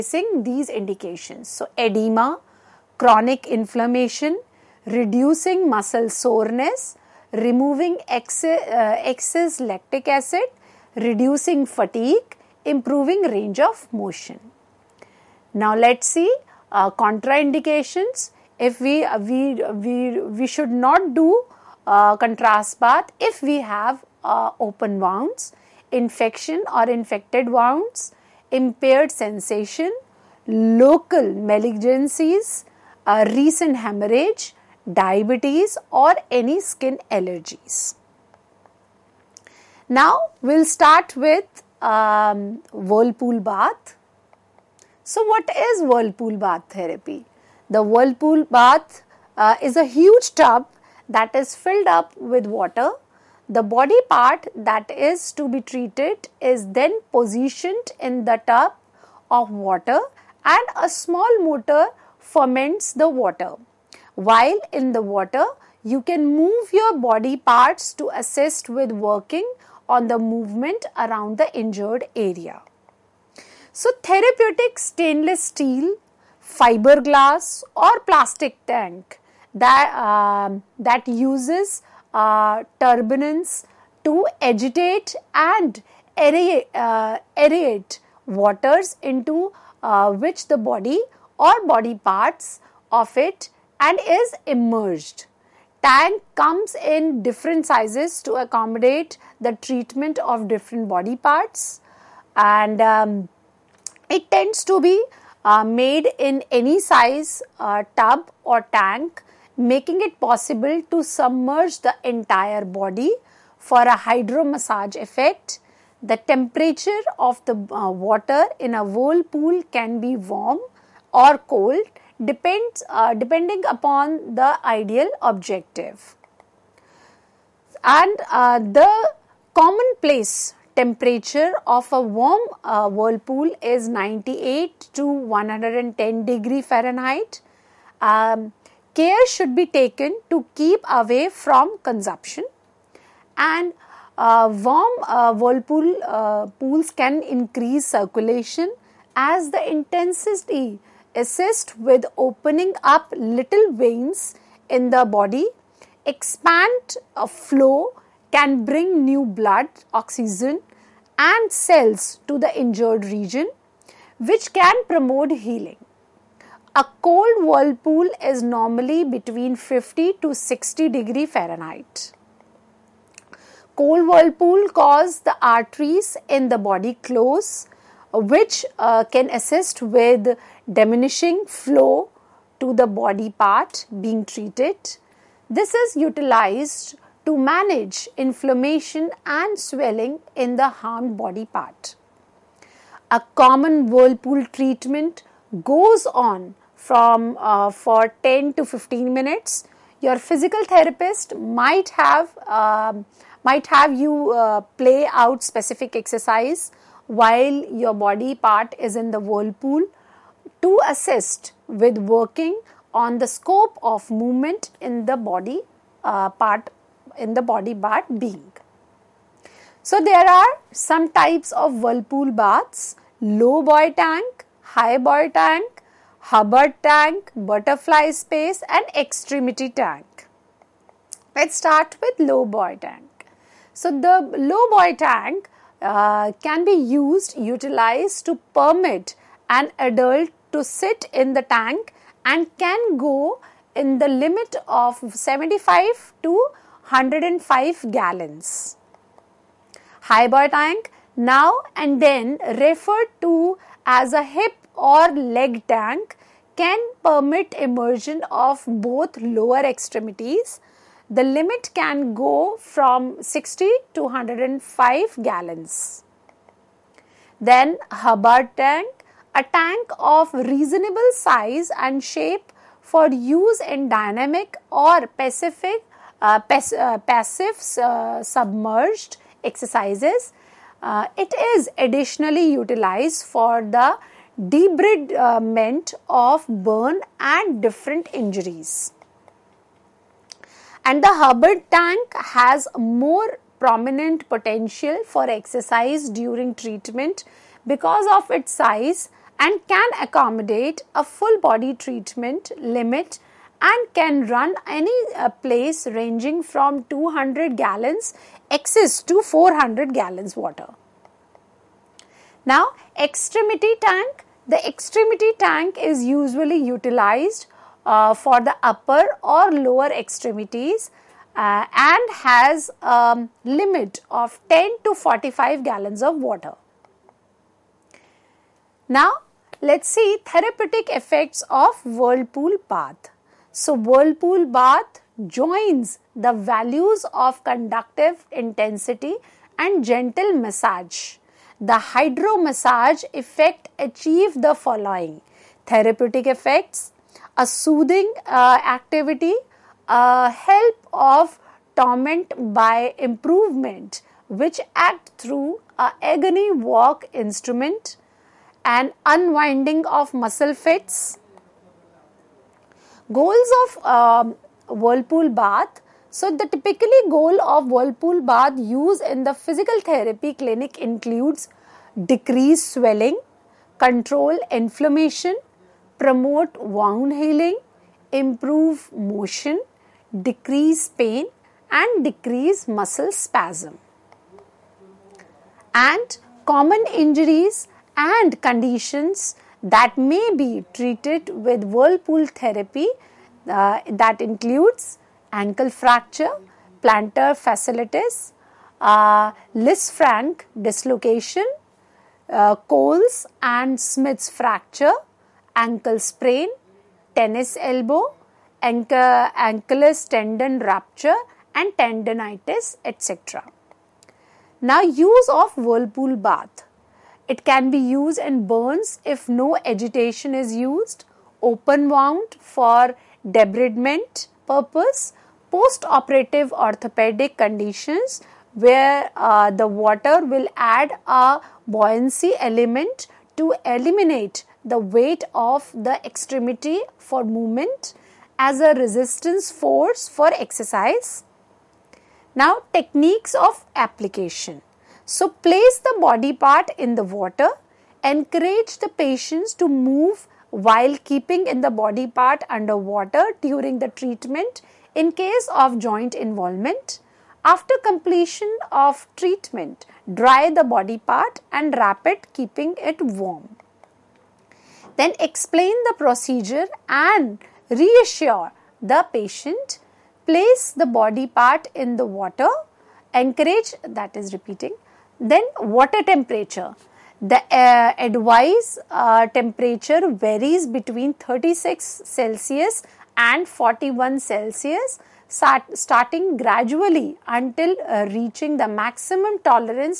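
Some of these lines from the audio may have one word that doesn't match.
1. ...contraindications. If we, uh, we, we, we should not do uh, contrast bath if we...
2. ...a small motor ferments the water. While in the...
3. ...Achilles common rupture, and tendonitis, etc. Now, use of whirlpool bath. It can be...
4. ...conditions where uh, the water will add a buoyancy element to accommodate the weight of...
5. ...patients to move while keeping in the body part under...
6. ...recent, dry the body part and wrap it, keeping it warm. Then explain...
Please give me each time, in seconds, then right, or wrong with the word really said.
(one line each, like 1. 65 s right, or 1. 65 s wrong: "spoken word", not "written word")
1. 16 s right
2. 60 s right
3. 409 s wrong: "tendon", not "common"
4. 427 s wrong: "eliminate", not "accommodate"
5. 448 s right
6. 459 s wrong: "treatment", not "recent".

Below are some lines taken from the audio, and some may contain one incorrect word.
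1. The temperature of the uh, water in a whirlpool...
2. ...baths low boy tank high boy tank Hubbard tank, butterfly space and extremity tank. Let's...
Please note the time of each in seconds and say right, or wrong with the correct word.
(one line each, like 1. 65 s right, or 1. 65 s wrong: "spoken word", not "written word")
1. 116 s right
2. 222 s right.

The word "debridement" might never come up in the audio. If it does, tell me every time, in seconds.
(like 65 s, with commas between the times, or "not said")
284 s, 423 s.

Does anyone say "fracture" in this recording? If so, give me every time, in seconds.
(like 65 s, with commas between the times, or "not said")
395 s, 404 s.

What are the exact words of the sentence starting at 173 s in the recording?
Cold whirlpool cause the arteries in the body close, which uh, can assist with diminishing flow to the body part being treated.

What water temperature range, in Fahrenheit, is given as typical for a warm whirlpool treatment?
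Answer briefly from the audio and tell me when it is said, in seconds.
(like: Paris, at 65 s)
98 to 110 degrees Fahrenheit, at 133 s.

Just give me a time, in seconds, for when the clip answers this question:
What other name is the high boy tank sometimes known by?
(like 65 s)
254 s.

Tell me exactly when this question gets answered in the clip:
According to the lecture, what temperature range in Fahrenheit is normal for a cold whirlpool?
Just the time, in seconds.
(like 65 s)
169 s.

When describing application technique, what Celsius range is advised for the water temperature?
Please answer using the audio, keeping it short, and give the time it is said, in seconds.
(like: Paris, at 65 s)
36 to 41 °C, at 481 s.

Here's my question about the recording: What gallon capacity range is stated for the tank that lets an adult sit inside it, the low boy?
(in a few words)
75 to 105 gallons.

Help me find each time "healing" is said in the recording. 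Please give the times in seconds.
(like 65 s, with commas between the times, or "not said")
165 s, 377 s.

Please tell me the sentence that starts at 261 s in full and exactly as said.
The limit can go from 60 to 105 gallons.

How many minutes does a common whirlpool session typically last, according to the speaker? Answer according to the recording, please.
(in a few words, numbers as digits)
10 to 15 minutes.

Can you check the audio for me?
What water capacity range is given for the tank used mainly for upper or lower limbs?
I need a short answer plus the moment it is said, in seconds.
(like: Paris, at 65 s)
10 to 45 gallons, at 324 s.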